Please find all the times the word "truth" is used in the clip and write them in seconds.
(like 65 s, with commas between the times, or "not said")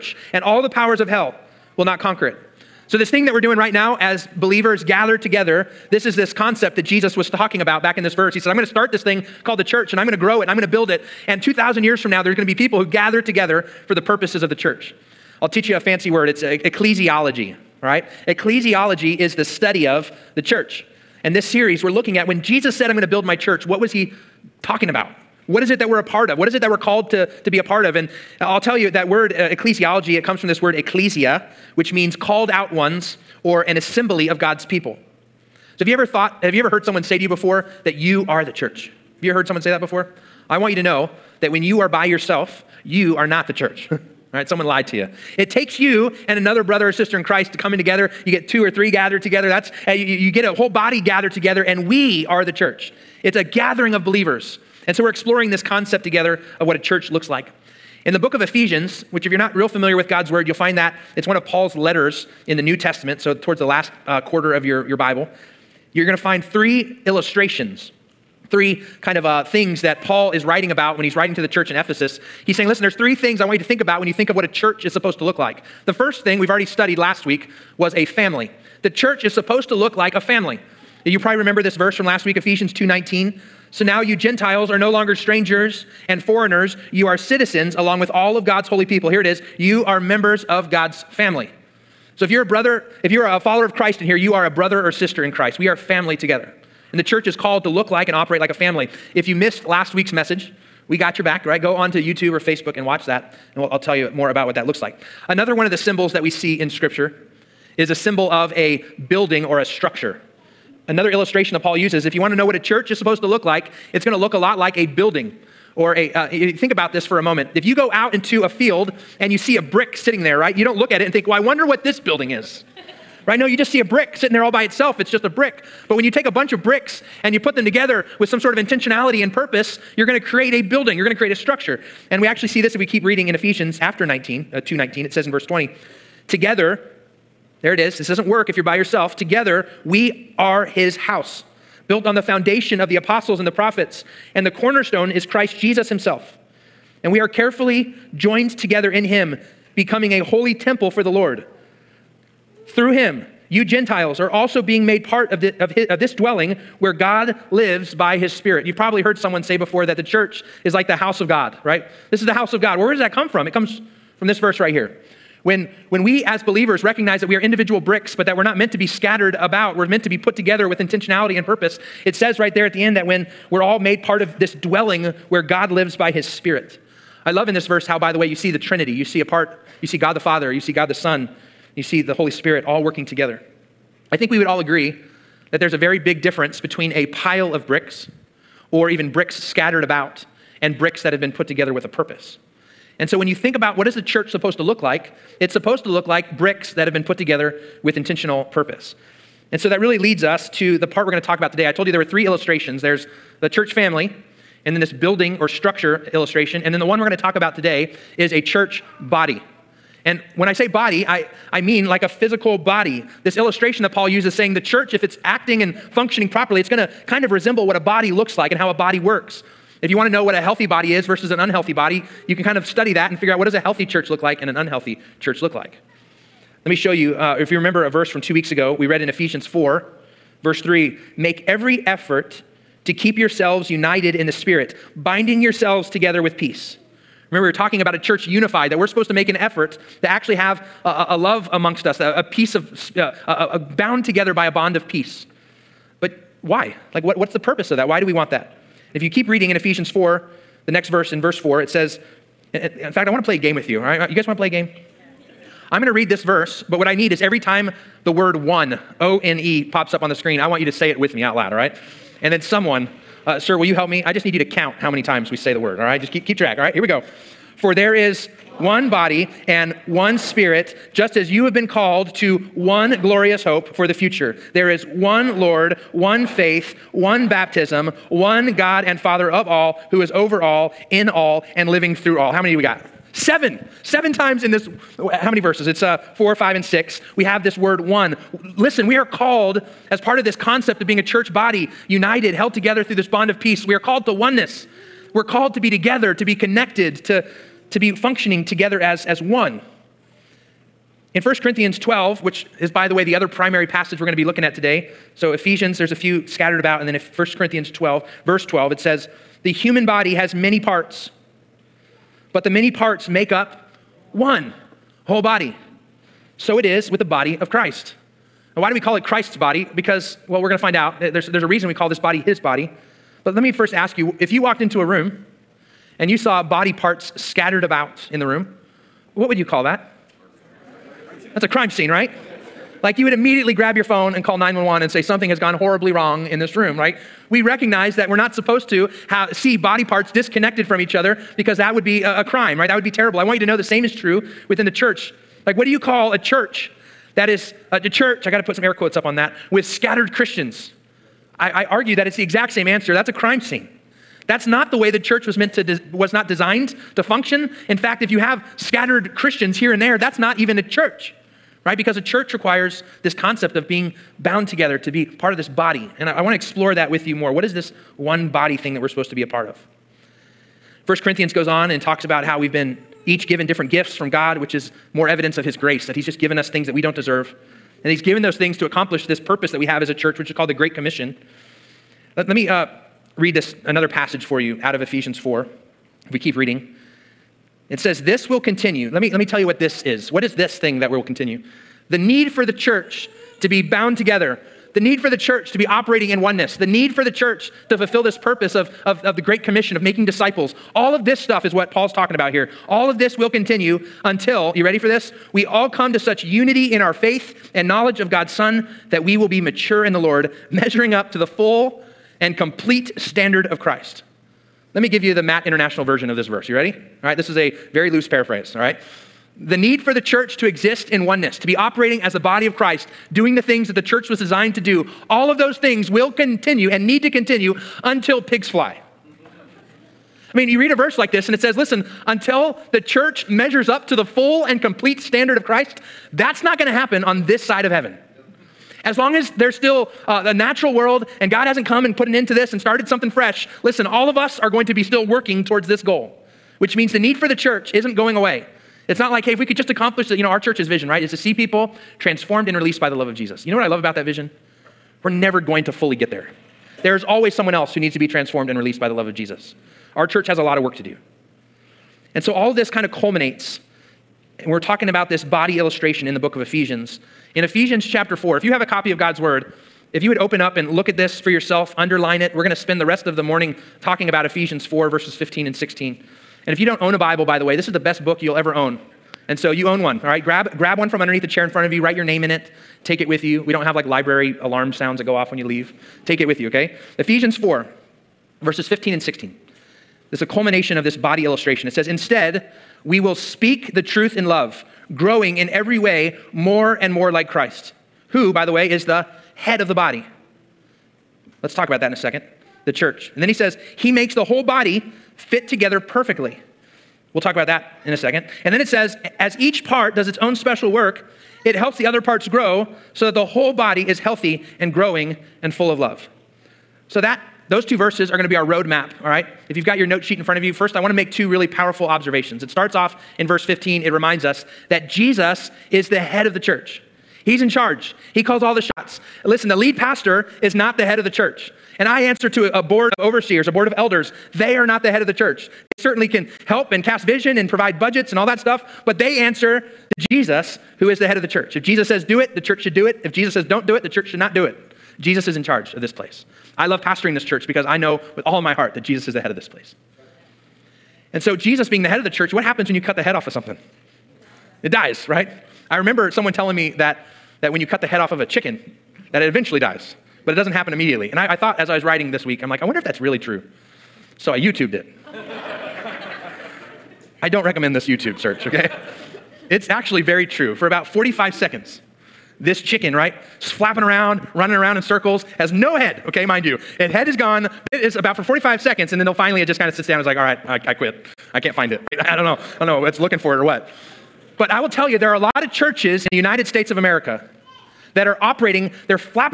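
493 s.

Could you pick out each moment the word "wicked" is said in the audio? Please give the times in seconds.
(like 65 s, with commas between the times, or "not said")
not said.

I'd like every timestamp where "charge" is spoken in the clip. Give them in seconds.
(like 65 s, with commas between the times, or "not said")
527 s, 545 s.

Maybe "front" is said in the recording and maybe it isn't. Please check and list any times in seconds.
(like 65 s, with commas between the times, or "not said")
481 s, 520 s.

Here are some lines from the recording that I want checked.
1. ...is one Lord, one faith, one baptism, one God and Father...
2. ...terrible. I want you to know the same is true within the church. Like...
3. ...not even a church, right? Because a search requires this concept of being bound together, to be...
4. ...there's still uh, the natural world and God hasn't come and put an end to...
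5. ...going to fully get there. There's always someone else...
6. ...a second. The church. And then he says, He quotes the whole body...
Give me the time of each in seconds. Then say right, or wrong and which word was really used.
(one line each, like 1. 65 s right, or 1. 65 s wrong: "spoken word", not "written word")
1. 274 s right
2. 342 s right
3. 360 s wrong: "church", not "search"
4. 439 s right
5. 455 s right
6. 501 s wrong: "makes", not "quotes".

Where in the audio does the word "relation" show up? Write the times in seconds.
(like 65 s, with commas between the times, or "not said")
not said.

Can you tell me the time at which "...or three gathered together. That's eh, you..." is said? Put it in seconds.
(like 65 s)
48 s.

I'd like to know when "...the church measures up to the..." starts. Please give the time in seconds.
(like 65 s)
432 s.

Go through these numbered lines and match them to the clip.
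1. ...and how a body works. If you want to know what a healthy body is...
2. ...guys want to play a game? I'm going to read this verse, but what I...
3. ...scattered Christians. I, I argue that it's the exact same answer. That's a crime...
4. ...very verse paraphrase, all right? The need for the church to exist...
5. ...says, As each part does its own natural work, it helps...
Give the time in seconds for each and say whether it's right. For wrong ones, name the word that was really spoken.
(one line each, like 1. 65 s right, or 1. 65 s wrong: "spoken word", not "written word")
1. 218 s right
2. 254 s right
3. 349 s right
4. 417 s wrong: "loose", not "verse"
5. 508 s wrong: "special", not "natural".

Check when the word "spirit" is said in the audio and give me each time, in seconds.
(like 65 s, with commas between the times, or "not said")
158 s, 176 s, 182 s, 234 s, 270 s.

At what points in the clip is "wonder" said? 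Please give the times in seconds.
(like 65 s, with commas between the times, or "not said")
121 s, 562 s.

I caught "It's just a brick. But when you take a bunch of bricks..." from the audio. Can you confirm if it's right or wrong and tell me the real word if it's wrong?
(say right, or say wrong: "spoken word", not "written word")
right.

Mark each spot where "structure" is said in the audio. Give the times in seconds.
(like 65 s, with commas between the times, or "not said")
109 s, 131 s, 205 s.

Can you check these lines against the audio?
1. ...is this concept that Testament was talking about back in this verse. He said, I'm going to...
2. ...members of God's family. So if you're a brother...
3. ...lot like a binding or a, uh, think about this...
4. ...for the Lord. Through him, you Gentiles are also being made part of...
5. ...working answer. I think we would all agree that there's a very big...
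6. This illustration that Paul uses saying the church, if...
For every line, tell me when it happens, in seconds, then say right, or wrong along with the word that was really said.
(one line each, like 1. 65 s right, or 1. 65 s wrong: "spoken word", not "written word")
1. 6 s wrong: "Jesus", not "Testament"
2. 89 s right
3. 114 s wrong: "building", not "binding"
4. 150 s right
5. 182 s wrong: "together", not "answer"
6. 213 s right.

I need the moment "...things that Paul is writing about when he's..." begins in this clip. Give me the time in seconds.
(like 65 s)
69 s.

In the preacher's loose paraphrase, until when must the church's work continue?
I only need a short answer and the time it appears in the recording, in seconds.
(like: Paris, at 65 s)
pigs fly, at 428 s.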